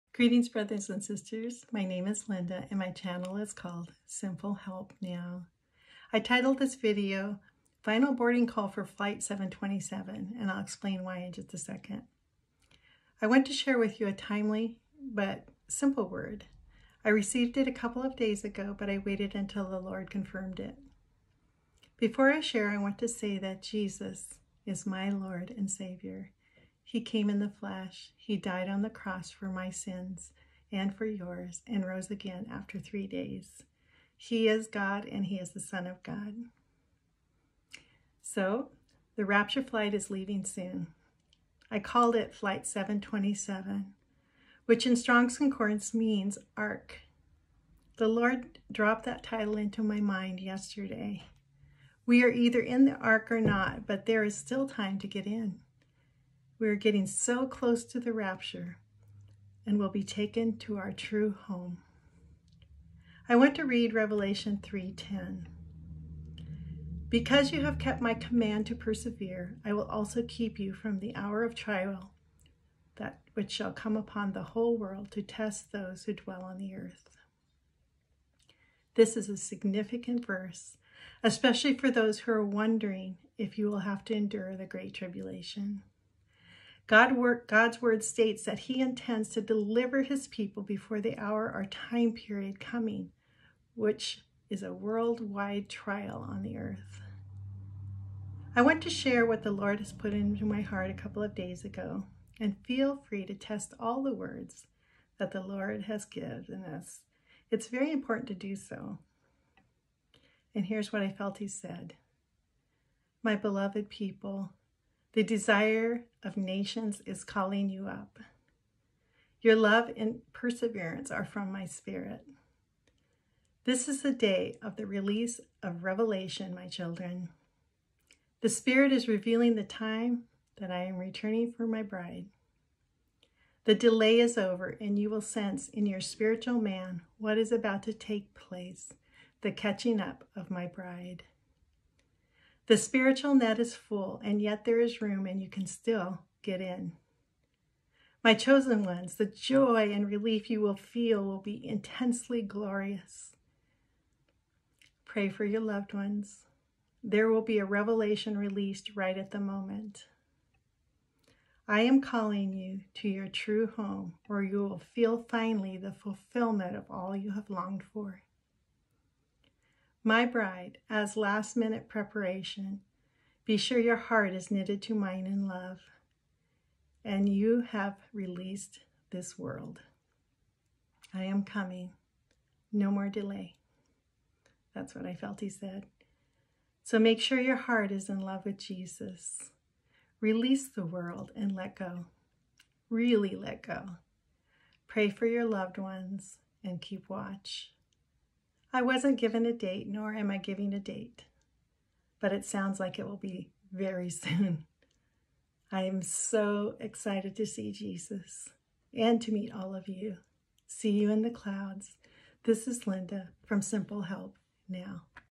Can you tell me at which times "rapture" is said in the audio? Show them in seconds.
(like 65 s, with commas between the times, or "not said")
39 s, 58 s.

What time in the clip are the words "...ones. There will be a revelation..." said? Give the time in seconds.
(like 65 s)
155 s.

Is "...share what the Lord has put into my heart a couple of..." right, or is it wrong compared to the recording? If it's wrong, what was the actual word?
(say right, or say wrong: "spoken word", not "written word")
right.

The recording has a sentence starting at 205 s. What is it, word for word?
I am so excited to see Jesus and to meet all of you.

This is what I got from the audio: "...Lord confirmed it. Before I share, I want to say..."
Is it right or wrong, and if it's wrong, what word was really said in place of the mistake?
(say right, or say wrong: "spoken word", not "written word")
right.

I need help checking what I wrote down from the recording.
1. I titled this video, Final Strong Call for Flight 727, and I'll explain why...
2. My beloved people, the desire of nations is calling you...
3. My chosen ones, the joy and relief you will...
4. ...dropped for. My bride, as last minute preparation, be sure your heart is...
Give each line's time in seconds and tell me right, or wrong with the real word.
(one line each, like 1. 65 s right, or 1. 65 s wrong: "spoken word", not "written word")
1. 6 s wrong: "Boarding", not "Strong"
2. 113 s right
3. 148 s right
4. 167 s wrong: "longed", not "dropped".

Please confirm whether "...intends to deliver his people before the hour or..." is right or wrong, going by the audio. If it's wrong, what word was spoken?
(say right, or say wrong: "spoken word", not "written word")
right.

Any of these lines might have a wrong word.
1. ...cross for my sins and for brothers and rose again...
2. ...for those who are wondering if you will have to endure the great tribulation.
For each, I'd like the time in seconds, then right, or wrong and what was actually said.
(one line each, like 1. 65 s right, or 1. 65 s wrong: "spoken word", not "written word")
1. 28 s wrong: "yours", not "brothers"
2. 81 s right.